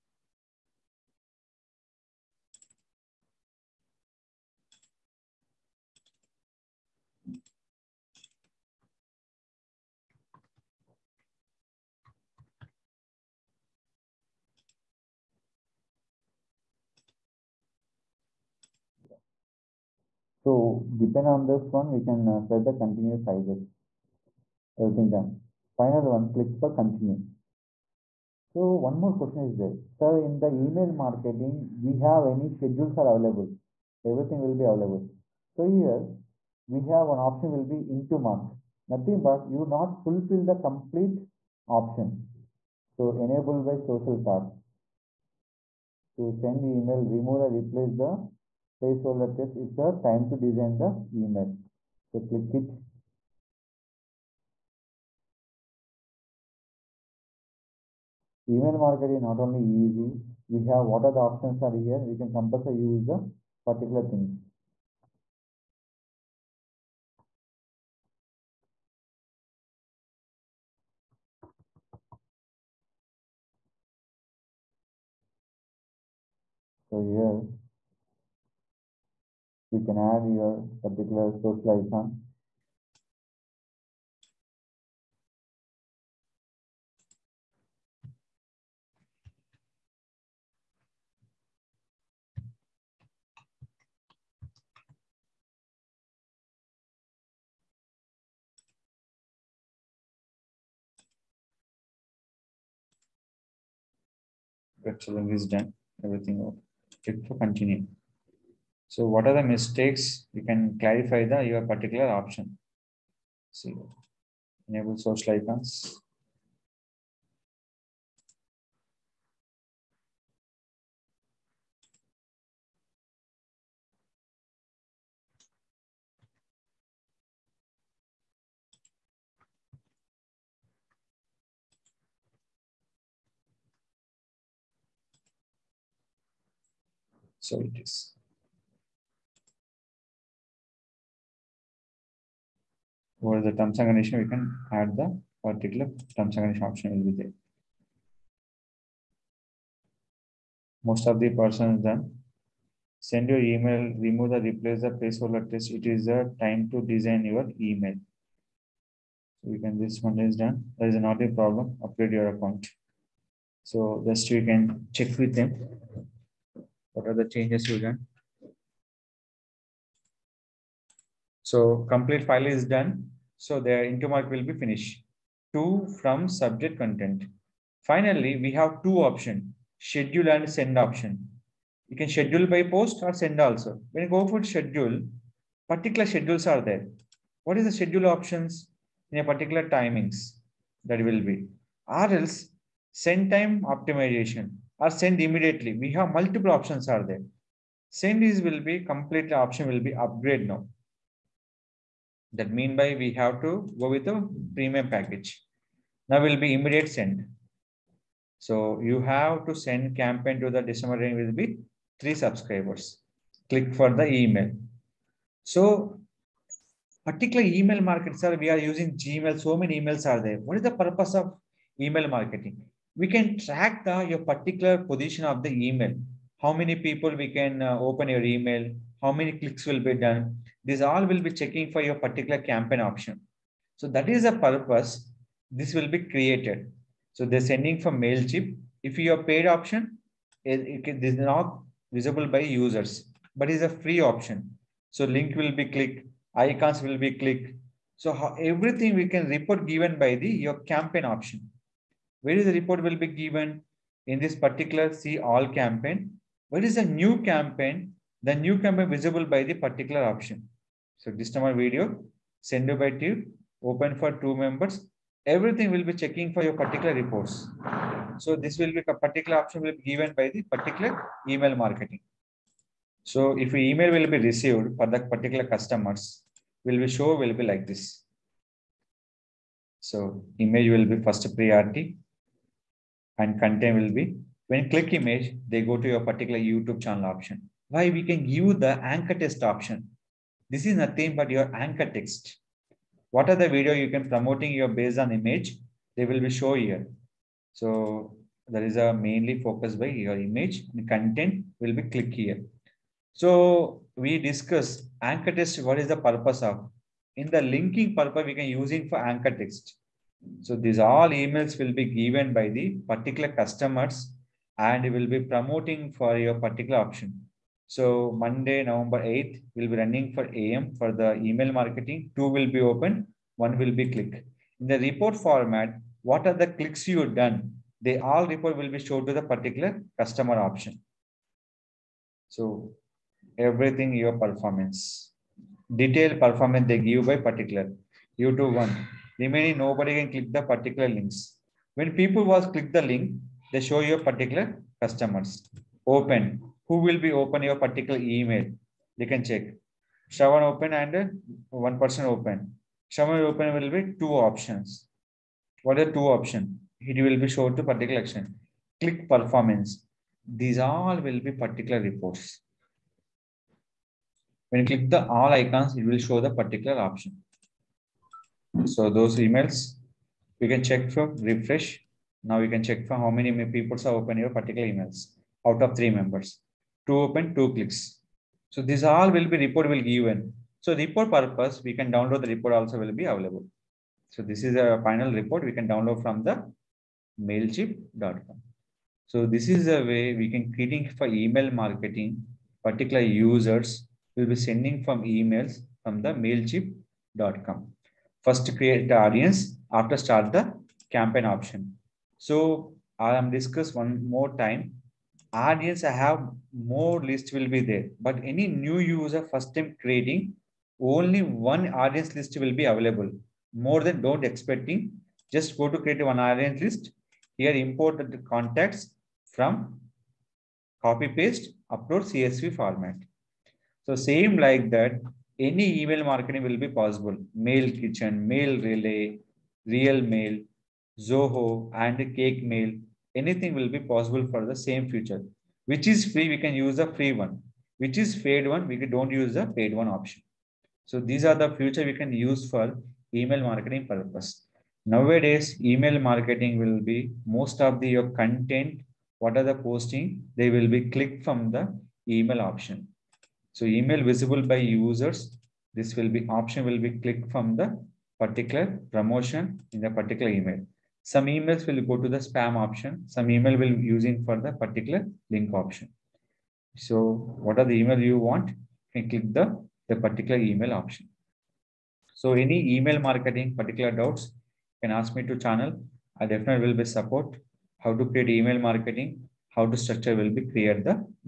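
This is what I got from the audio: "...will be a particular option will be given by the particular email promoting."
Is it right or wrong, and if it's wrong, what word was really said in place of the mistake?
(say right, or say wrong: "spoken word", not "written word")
wrong: "marketing", not "promoting".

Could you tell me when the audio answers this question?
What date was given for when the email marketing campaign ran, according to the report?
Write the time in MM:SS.
05:18.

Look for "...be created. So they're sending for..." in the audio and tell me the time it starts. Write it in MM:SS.
03:55.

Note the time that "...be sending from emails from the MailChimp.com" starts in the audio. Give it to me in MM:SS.
06:34.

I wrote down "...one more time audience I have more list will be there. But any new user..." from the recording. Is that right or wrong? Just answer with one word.
right.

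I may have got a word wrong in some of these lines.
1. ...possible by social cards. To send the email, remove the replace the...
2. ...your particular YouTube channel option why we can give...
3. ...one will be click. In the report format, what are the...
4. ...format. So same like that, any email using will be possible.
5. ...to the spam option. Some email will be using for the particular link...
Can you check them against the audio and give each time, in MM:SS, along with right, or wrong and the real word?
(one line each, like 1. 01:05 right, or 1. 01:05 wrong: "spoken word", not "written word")
1. 00:43 wrong: "enable", not "possible"
2. 04:45 right
3. 05:23 right
4. 07:02 wrong: "marketing", not "using"
5. 07:42 right.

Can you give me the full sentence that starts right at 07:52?
So any email marketing particular doubts, can ask me to channel.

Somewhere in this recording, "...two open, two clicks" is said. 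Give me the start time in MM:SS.
06:16.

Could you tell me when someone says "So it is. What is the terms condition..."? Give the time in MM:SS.
02:17.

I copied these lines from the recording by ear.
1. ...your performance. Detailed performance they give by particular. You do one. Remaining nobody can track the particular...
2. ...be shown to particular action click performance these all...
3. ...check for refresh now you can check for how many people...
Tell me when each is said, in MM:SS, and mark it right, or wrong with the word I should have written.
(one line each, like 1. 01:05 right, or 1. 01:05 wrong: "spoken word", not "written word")
1. 05:33 wrong: "click", not "track"
2. 05:57 right
3. 06:10 right.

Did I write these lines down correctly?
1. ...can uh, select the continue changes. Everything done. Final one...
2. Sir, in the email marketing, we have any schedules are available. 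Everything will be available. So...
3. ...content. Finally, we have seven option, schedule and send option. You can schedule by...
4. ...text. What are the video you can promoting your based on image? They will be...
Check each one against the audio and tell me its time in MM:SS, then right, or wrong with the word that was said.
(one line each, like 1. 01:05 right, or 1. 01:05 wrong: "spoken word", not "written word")
1. 00:22 wrong: "sizes", not "changes"
2. 00:29 right
3. 02:56 wrong: "two", not "seven"
4. 04:51 right.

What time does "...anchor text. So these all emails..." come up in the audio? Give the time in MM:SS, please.
05:09.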